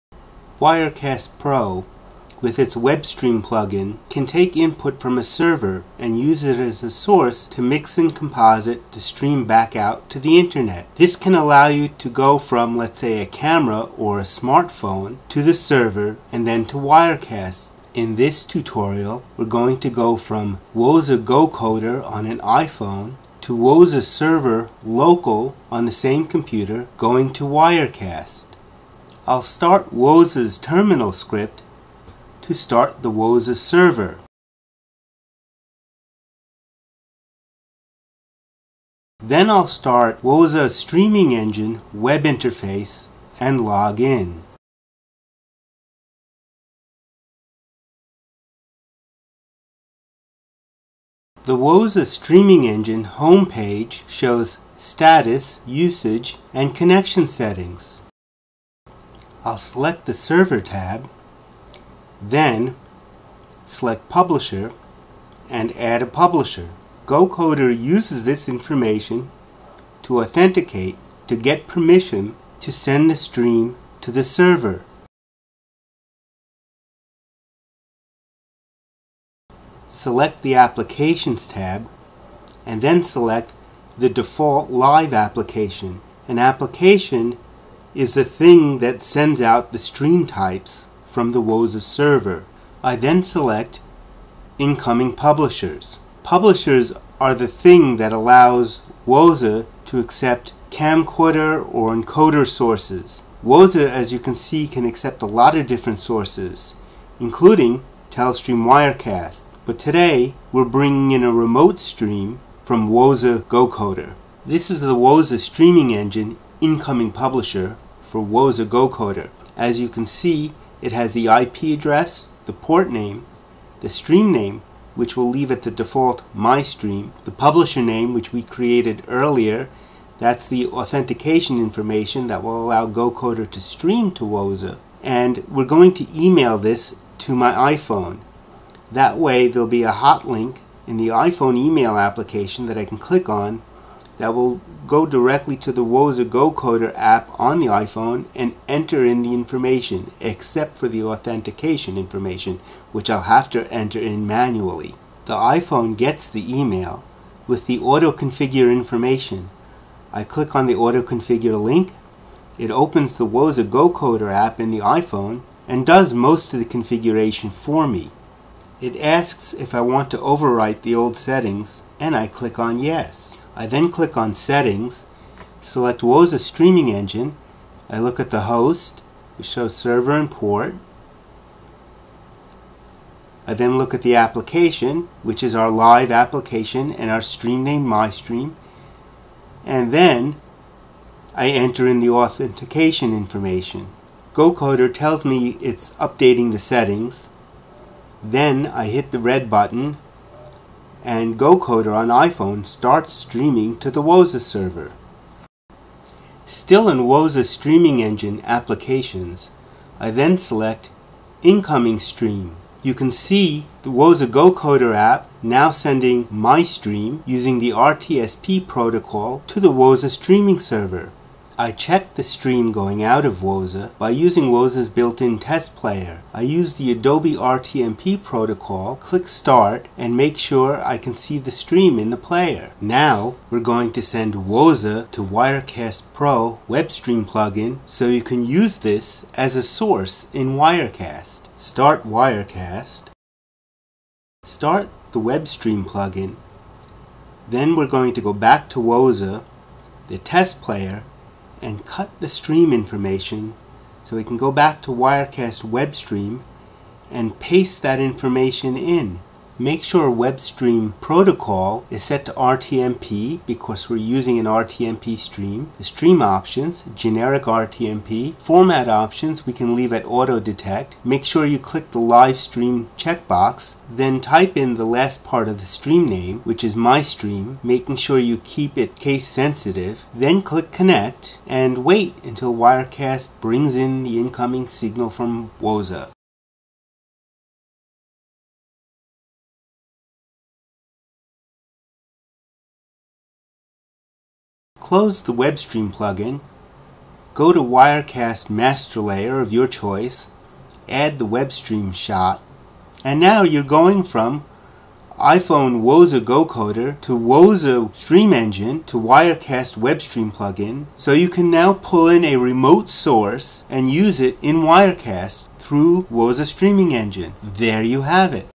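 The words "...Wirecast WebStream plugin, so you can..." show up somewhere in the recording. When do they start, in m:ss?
5:08.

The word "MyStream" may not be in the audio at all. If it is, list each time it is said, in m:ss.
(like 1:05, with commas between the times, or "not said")
3:07.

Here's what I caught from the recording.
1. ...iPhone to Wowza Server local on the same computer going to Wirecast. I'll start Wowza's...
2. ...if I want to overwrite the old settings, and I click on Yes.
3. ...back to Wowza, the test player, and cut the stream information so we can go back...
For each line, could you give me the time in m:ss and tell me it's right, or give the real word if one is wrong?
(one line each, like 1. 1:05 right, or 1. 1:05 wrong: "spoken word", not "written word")
1. 0:22 right
2. 2:49 right
3. 4:08 right.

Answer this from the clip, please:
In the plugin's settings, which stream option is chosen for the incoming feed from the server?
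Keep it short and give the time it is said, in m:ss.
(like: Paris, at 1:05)
generic RTMP, at 4:26.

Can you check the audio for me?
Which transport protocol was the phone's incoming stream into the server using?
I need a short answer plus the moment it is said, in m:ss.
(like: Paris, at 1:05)
RTSP, at 3:37.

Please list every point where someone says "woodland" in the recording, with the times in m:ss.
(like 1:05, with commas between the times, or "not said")
not said.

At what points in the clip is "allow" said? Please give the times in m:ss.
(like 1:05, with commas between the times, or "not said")
0:11, 1:38, 2:12.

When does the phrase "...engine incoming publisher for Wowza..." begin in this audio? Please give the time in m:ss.
1:55.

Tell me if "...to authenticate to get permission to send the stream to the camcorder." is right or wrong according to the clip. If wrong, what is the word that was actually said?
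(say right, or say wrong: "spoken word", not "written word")
wrong: "server", not "camcorder".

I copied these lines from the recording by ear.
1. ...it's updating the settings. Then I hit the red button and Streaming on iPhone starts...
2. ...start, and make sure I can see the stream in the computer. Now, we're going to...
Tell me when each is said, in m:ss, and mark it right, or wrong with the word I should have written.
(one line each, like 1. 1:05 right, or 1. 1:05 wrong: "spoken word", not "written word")
1. 3:15 wrong: "GoCoder", not "Streaming"
2. 3:49 wrong: "player", not "computer".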